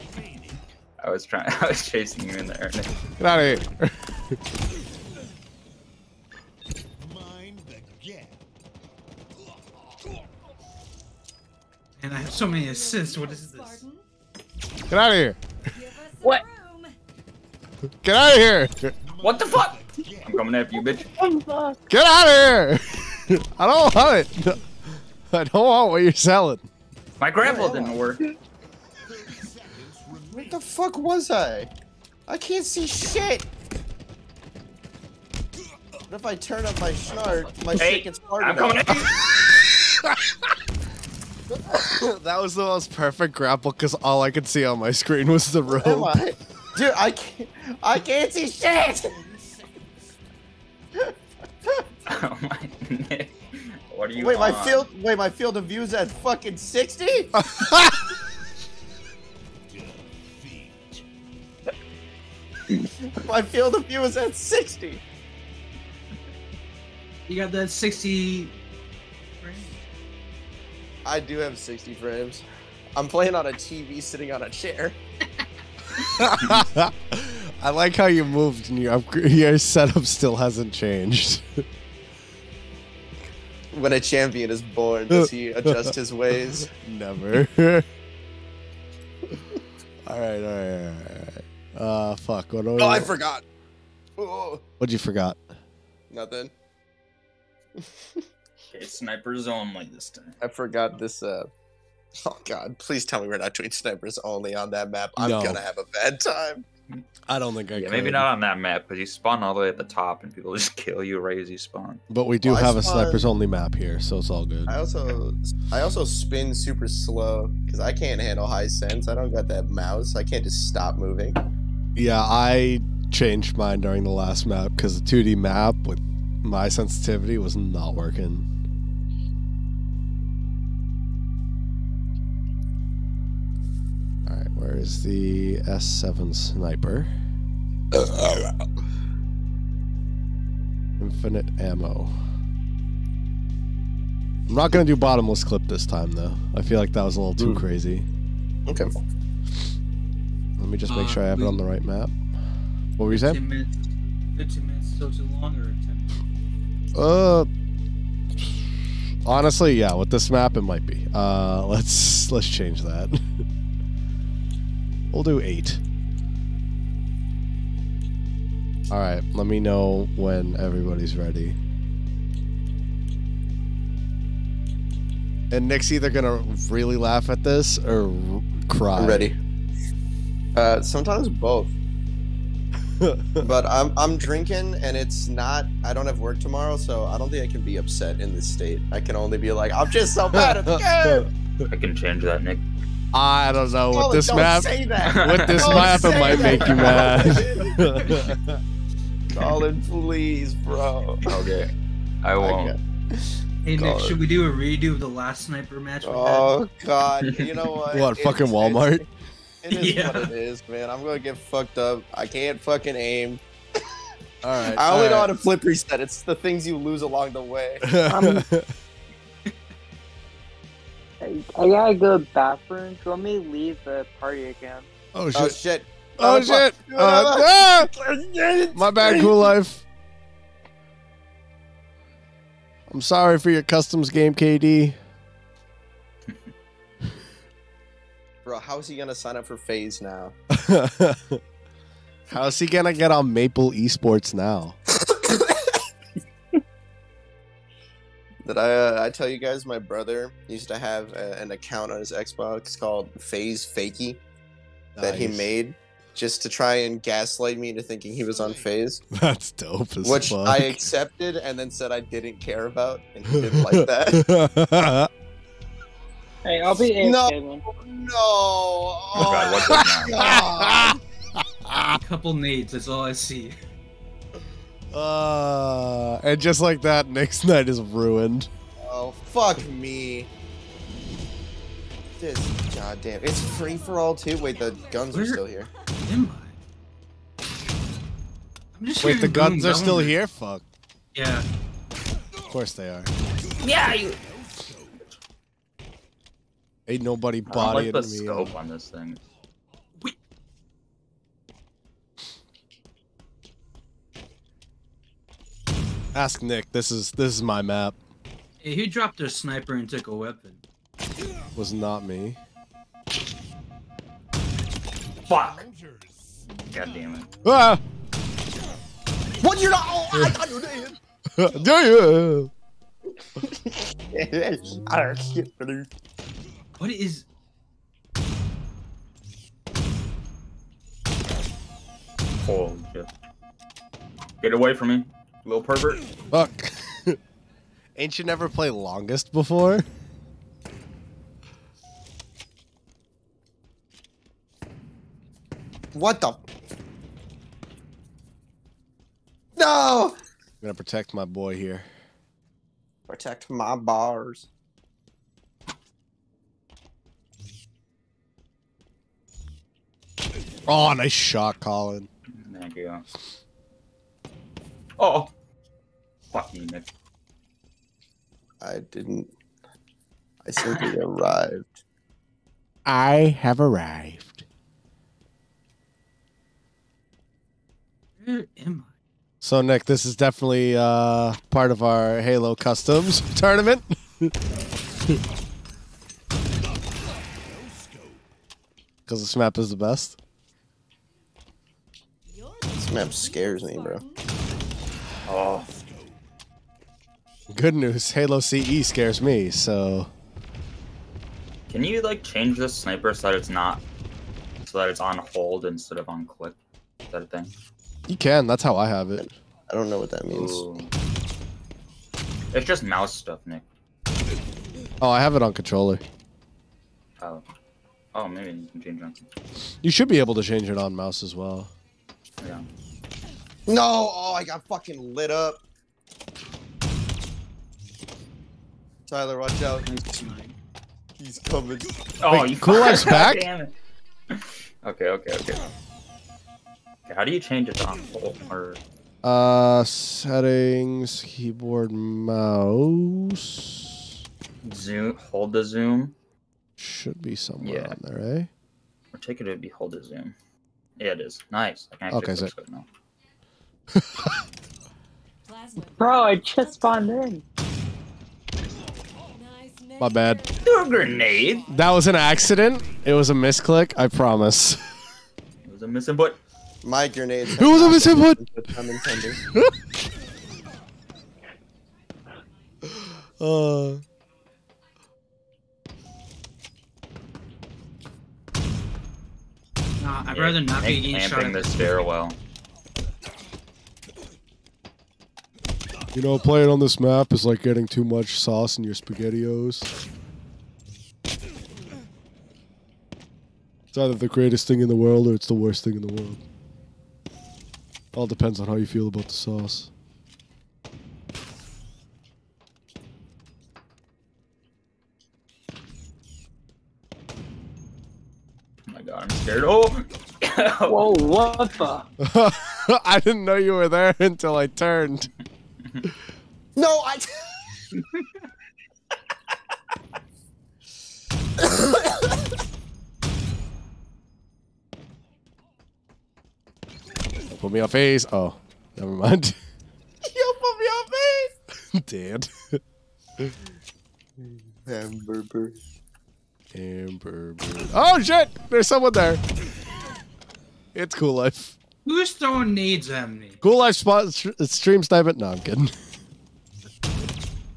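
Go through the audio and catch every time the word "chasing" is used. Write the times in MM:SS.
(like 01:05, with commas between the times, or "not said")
00:01.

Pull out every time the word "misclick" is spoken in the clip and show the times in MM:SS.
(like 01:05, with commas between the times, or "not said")
07:43.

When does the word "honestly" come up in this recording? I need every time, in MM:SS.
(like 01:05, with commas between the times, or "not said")
02:39.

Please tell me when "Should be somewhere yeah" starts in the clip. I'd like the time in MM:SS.
07:26.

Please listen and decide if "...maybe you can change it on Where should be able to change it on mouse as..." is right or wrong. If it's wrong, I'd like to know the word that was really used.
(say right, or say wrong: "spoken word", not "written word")
wrong: "You", not "Where".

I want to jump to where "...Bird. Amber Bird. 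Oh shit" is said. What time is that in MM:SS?
08:55.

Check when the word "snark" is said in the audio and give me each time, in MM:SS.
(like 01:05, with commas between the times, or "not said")
00:36.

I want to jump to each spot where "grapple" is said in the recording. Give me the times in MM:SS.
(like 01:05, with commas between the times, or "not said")
00:27, 00:43.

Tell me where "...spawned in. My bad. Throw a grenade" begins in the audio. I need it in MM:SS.
07:36.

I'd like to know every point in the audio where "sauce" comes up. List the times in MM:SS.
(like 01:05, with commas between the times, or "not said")
08:08, 08:19.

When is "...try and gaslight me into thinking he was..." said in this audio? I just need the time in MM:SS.
04:16.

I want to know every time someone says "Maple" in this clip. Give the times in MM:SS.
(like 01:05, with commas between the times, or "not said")
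04:03.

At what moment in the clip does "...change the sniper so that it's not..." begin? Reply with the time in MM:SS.
06:42.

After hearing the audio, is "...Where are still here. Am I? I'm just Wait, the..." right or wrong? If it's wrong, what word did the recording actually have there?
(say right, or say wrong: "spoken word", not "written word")
right.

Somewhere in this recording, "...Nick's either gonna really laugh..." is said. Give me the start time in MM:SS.
02:55.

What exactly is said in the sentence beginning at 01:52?
But we do well, have spawn...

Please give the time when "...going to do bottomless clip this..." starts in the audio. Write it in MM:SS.
02:24.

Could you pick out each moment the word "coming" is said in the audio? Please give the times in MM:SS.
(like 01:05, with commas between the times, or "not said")
00:20, 00:38, 07:11.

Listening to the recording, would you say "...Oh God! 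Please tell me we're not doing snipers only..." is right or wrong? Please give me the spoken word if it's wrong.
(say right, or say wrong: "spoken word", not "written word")
right.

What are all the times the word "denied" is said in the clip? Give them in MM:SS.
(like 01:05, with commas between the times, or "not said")
not said.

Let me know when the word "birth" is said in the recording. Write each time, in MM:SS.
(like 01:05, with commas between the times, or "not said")
not said.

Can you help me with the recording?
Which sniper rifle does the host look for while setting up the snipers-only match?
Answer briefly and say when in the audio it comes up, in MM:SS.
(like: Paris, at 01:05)
S7 sniper, at 02:15.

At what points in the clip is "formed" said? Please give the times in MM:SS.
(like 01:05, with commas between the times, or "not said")
not said.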